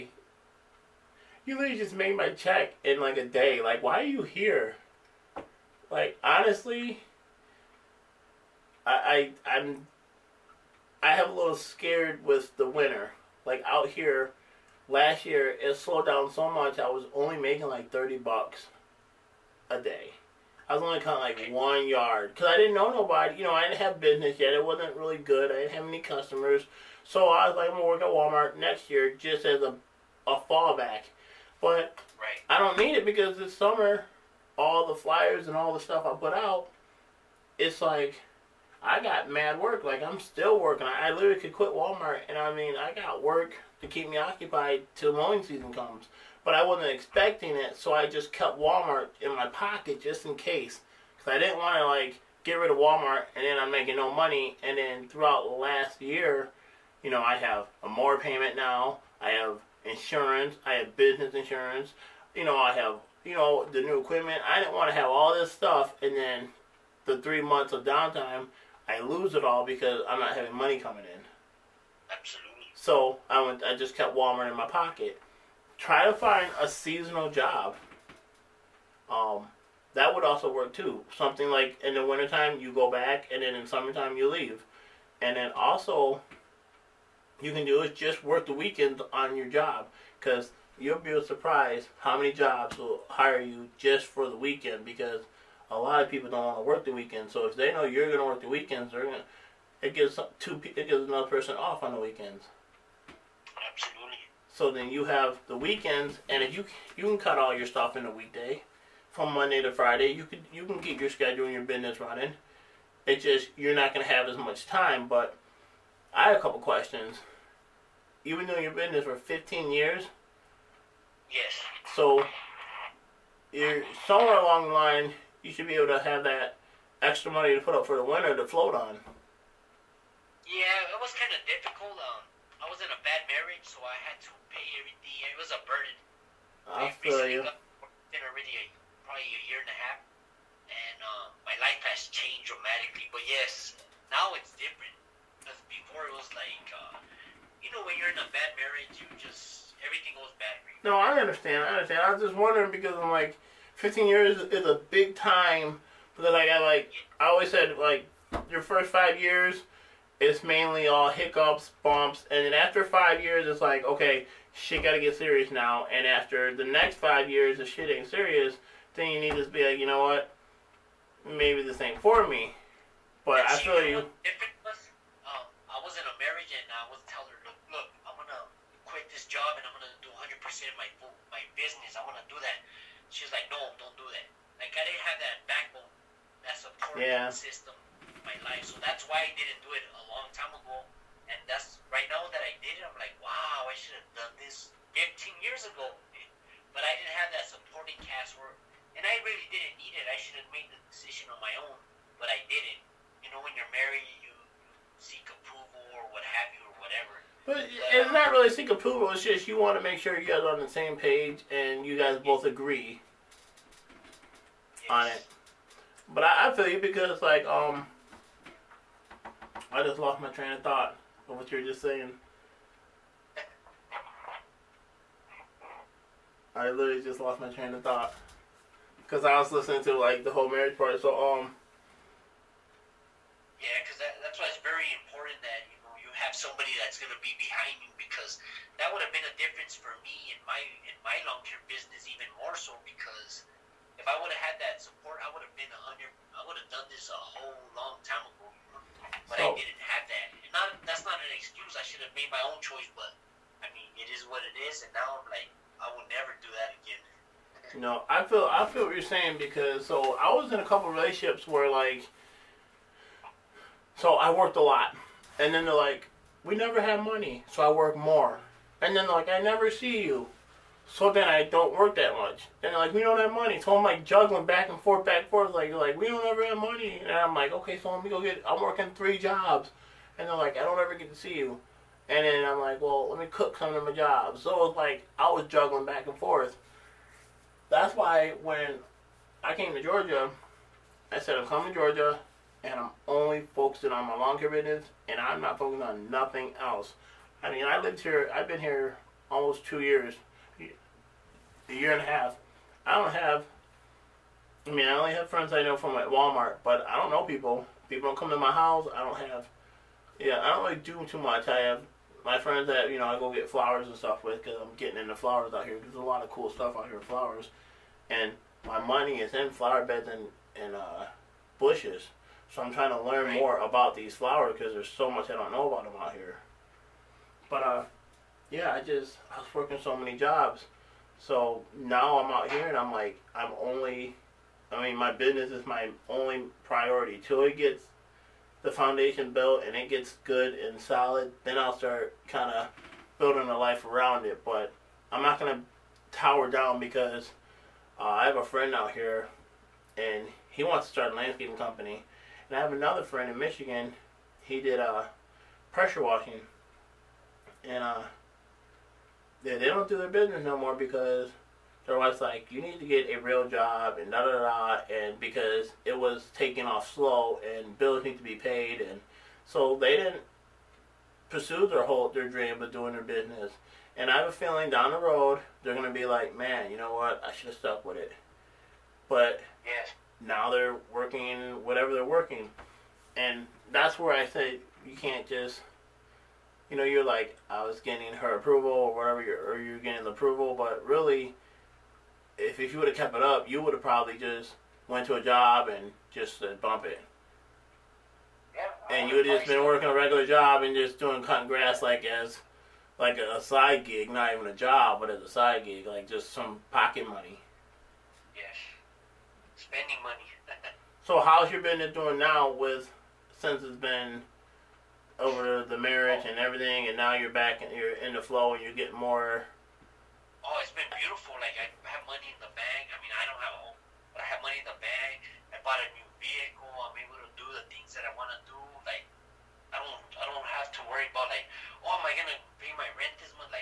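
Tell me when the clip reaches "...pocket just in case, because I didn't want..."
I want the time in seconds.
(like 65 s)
49 s.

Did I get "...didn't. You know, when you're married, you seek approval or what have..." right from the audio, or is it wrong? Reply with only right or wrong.
right.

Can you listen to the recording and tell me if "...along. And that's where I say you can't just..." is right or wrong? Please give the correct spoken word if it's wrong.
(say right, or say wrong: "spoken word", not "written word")
wrong: "working", not "along".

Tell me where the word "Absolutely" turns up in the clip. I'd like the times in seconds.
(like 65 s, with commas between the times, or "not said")
72 s, 103 s.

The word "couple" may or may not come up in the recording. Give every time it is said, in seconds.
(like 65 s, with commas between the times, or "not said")
116 s, 260 s.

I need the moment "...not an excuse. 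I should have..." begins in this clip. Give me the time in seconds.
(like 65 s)
251 s.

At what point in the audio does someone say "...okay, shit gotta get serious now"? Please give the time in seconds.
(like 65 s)
163 s.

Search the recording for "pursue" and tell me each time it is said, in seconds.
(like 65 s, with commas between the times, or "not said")
371 s.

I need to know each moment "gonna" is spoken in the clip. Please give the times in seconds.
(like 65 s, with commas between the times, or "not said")
345 s, 375 s, 432 s.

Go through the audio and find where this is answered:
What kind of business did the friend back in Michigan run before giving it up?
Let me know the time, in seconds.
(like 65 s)
355 s.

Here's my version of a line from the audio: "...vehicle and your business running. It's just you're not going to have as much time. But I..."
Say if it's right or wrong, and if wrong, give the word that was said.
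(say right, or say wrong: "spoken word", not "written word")
wrong: "schedule", not "vehicle".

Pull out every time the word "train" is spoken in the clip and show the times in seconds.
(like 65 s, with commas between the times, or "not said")
220 s, 227 s.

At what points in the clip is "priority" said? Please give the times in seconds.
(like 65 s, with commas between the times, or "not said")
336 s.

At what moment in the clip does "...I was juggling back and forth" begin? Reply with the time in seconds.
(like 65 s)
285 s.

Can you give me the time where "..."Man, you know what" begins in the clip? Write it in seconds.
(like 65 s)
376 s.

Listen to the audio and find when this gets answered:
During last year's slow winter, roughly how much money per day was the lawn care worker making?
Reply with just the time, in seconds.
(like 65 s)
17 s.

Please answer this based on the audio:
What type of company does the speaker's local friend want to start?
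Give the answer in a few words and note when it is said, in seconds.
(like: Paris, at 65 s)
landscaping company, at 351 s.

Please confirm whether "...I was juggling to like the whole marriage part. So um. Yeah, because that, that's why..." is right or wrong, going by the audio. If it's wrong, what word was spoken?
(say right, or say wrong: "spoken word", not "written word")
wrong: "listening", not "juggling".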